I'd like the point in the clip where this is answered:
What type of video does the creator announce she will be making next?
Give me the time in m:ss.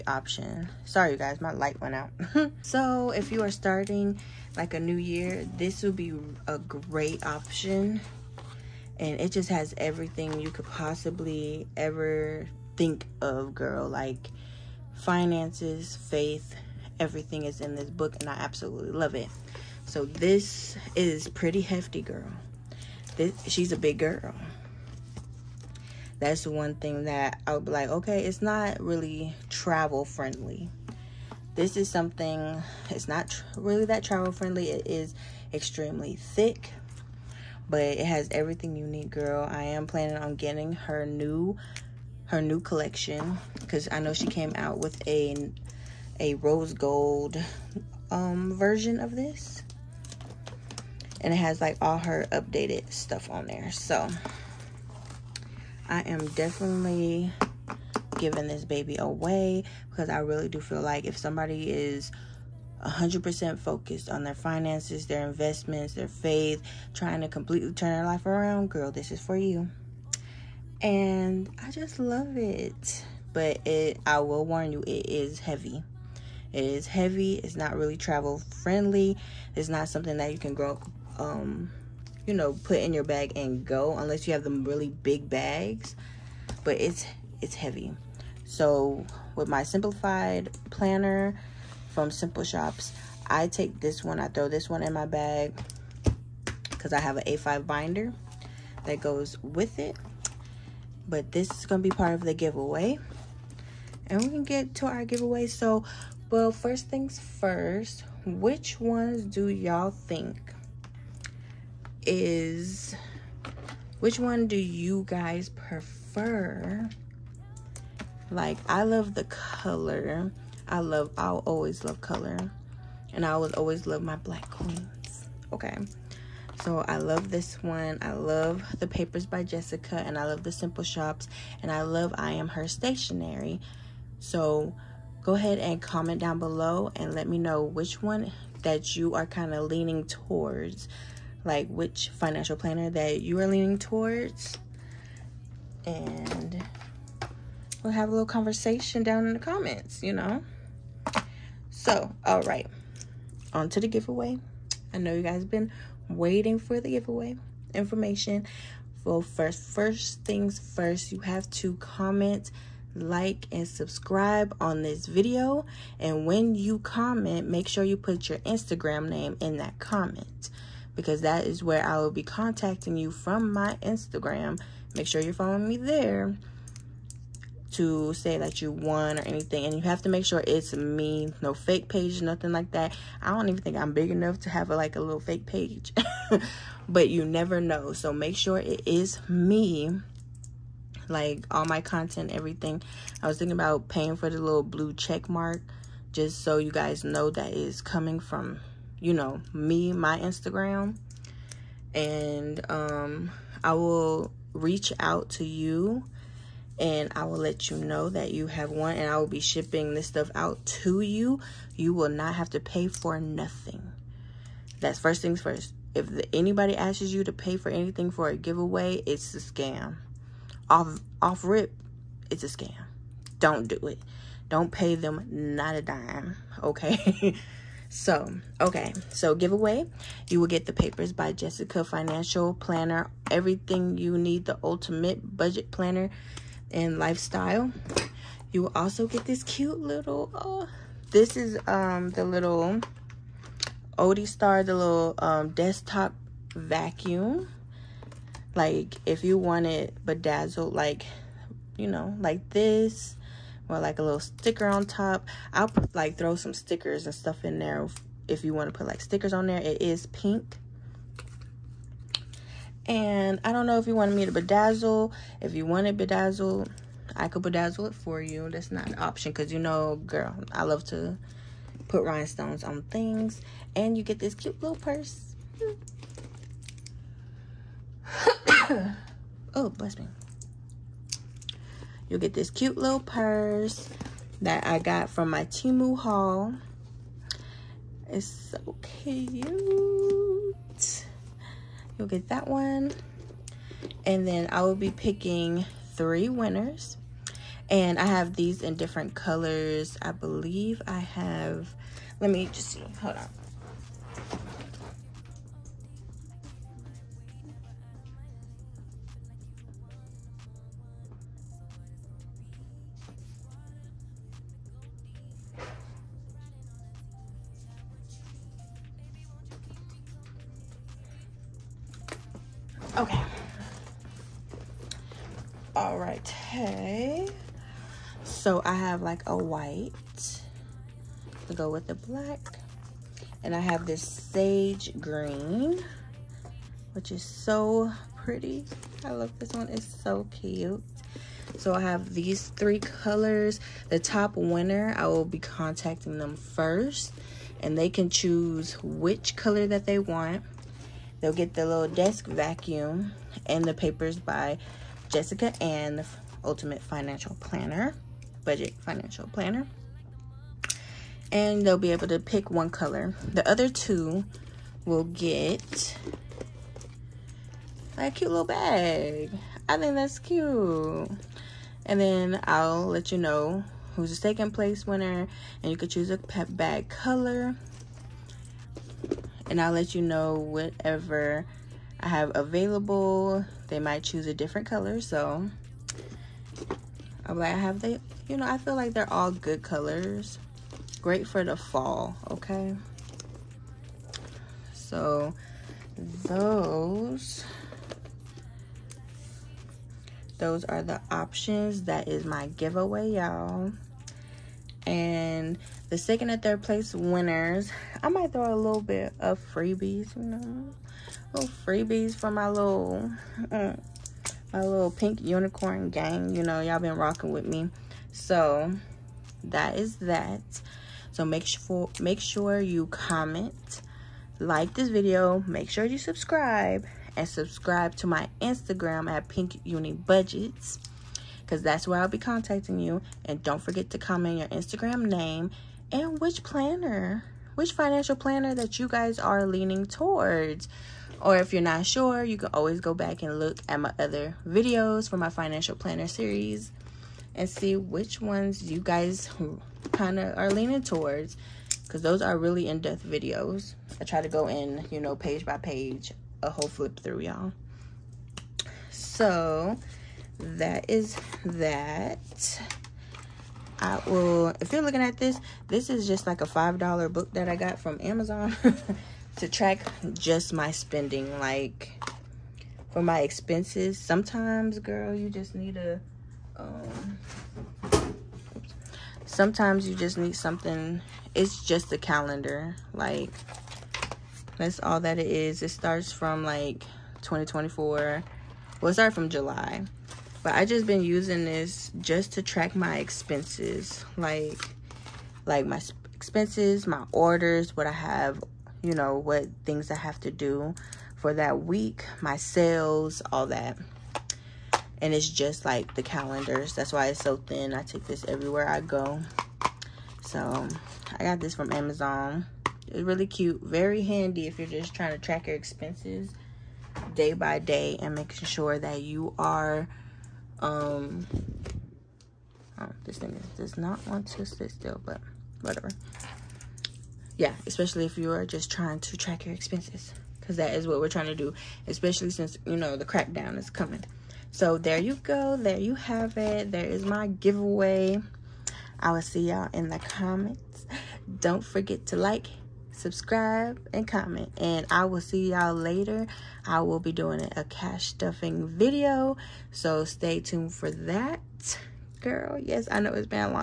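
9:07.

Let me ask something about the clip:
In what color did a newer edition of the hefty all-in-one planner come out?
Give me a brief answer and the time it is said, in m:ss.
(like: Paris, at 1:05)
Rose gold, at 0:46.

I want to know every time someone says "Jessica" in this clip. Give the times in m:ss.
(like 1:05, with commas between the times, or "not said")
2:09, 3:51, 5:55.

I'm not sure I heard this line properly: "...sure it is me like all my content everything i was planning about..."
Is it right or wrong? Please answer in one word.
wrong.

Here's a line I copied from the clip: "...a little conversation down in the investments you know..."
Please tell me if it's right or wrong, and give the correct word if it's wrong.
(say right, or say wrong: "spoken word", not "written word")
wrong: "comments", not "investments".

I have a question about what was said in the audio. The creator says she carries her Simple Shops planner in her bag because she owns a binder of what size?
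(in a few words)
A5.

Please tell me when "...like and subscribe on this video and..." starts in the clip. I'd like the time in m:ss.
2:42.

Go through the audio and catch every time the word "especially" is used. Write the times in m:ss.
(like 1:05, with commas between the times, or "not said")
8:47, 8:51.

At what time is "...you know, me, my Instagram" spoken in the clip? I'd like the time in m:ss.
3:19.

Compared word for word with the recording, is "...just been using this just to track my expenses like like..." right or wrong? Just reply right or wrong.
right.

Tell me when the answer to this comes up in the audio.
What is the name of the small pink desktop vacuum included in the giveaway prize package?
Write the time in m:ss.
4:03.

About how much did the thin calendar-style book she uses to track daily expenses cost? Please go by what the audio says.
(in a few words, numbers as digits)
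$5.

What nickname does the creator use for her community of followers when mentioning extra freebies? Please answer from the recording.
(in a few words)
Pink unicorn gang.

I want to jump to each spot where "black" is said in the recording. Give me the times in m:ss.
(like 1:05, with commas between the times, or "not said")
2:04, 5:31.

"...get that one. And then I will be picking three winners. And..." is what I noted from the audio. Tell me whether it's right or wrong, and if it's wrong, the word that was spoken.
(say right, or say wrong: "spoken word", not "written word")
right.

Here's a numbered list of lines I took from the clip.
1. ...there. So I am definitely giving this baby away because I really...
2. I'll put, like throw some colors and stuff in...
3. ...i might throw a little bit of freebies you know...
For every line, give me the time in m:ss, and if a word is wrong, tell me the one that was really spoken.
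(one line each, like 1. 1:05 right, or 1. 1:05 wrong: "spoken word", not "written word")
1. 0:53 right
2. 4:15 wrong: "stickers", not "colors"
3. 6:48 right.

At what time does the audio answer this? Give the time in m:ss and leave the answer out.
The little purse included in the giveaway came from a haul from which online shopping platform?
4:45.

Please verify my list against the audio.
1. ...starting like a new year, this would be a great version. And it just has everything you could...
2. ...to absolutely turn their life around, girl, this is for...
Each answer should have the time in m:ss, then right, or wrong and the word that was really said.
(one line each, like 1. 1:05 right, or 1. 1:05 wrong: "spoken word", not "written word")
1. 0:03 wrong: "option", not "version"
2. 1:07 wrong: "completely", not "absolutely".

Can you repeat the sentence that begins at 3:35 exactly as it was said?
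If the, anybody asks you to pay for anything for a giveaway, it's a scam.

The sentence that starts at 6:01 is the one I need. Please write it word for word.
And they'll be able to pick one color.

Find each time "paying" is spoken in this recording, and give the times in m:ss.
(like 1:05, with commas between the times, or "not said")
3:13.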